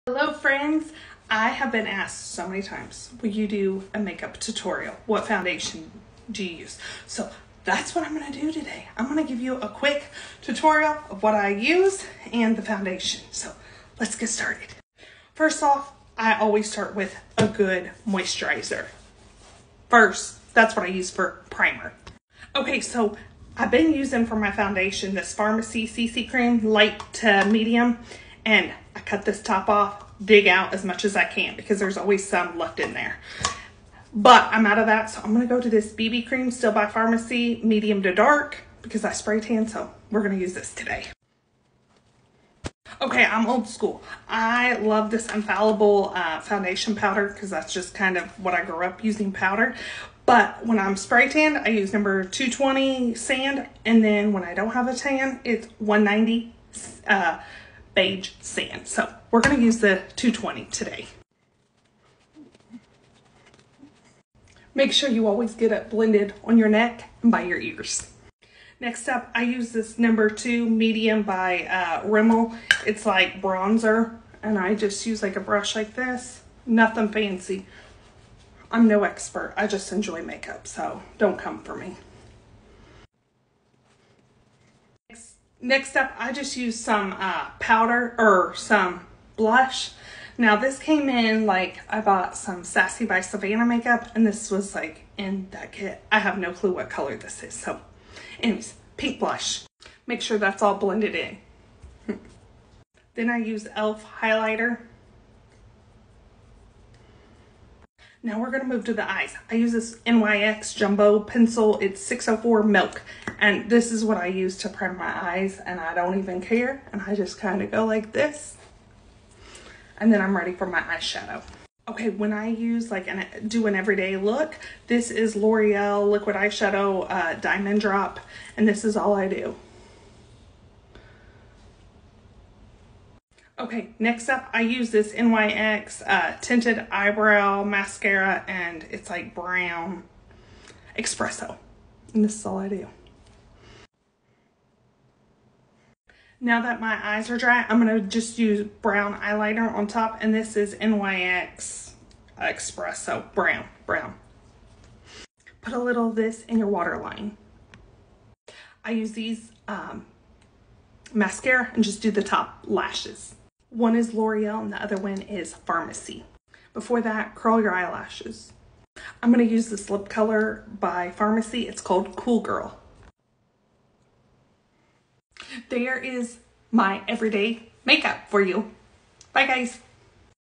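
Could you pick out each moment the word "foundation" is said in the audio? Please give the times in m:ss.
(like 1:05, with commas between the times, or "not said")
0:05, 0:12, 0:24, 0:46.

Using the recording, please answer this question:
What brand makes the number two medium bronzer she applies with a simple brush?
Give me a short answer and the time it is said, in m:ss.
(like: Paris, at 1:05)
Rimmel, at 1:12.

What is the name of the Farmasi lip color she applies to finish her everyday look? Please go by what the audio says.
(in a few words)
Cool Girl.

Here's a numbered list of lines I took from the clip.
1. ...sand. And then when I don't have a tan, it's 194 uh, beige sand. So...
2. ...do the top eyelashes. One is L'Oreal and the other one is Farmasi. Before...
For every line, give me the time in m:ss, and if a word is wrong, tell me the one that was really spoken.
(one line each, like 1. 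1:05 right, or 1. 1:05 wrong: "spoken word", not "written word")
1. 0:53 wrong: "190", not "194"
2. 2:42 wrong: "lashes", not "eyelashes".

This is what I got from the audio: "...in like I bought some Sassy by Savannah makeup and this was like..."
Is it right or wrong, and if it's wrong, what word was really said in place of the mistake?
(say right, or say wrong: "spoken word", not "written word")
right.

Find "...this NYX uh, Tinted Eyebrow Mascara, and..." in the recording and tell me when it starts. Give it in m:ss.
2:14.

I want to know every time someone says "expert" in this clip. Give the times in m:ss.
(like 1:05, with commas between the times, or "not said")
1:19.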